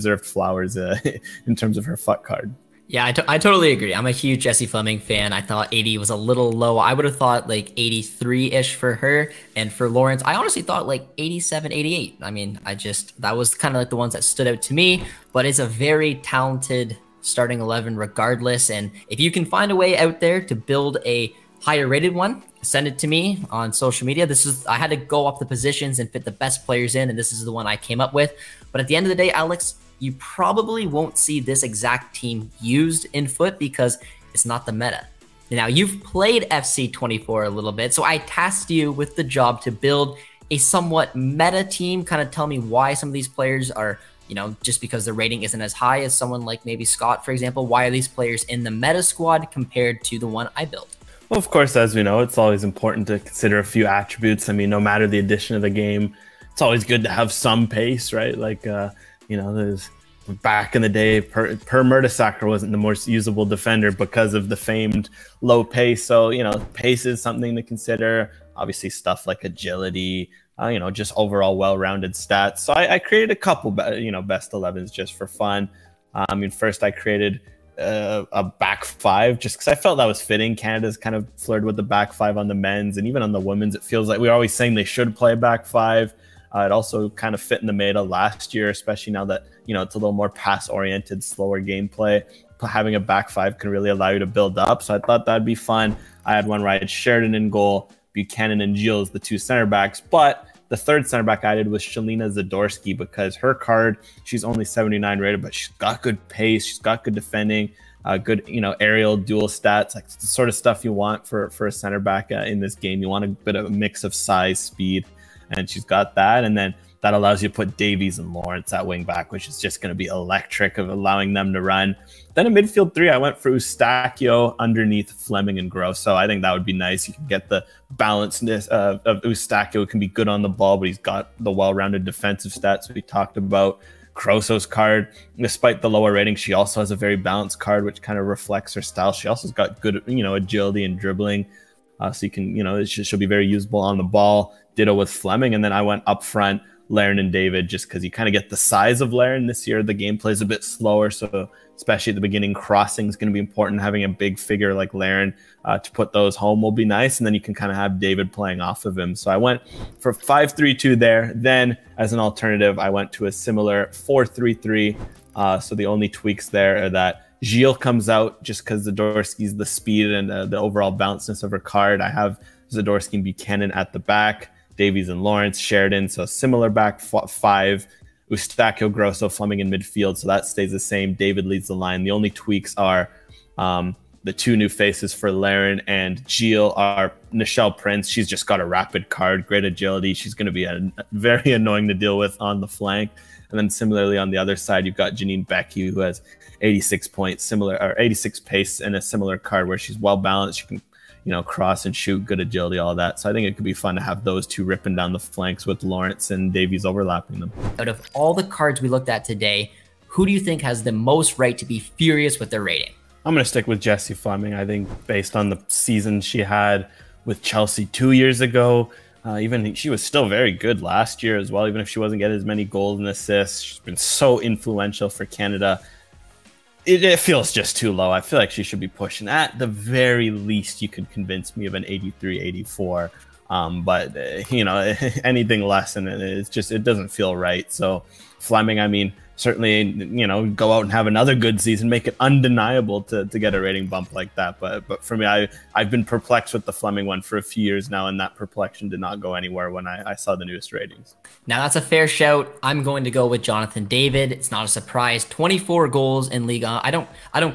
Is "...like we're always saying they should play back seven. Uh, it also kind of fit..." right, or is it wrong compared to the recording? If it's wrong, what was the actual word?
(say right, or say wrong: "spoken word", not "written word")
wrong: "five", not "seven".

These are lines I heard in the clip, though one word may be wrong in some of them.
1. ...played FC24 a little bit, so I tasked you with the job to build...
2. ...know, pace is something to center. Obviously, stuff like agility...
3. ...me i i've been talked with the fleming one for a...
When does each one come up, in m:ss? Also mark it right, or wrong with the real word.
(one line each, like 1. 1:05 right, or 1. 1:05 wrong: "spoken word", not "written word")
1. 0:36 right
2. 1:06 wrong: "consider", not "center"
3. 4:05 wrong: "perplexed", not "talked".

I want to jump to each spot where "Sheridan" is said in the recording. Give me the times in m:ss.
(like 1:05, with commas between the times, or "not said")
1:36, 2:55.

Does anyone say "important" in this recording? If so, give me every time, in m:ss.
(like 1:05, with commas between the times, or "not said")
0:52, 2:33.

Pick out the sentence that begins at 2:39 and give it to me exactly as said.
So I went for five three two there.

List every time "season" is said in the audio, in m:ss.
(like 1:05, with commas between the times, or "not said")
3:35, 4:01.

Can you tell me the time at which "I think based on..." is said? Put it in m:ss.
3:34.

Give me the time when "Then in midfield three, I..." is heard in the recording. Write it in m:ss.
2:02.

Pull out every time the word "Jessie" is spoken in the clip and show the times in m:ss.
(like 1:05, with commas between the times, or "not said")
0:04, 3:33.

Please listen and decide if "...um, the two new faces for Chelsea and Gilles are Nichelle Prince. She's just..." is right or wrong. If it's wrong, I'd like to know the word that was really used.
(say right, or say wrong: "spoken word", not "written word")
wrong: "Larin", not "Chelsea".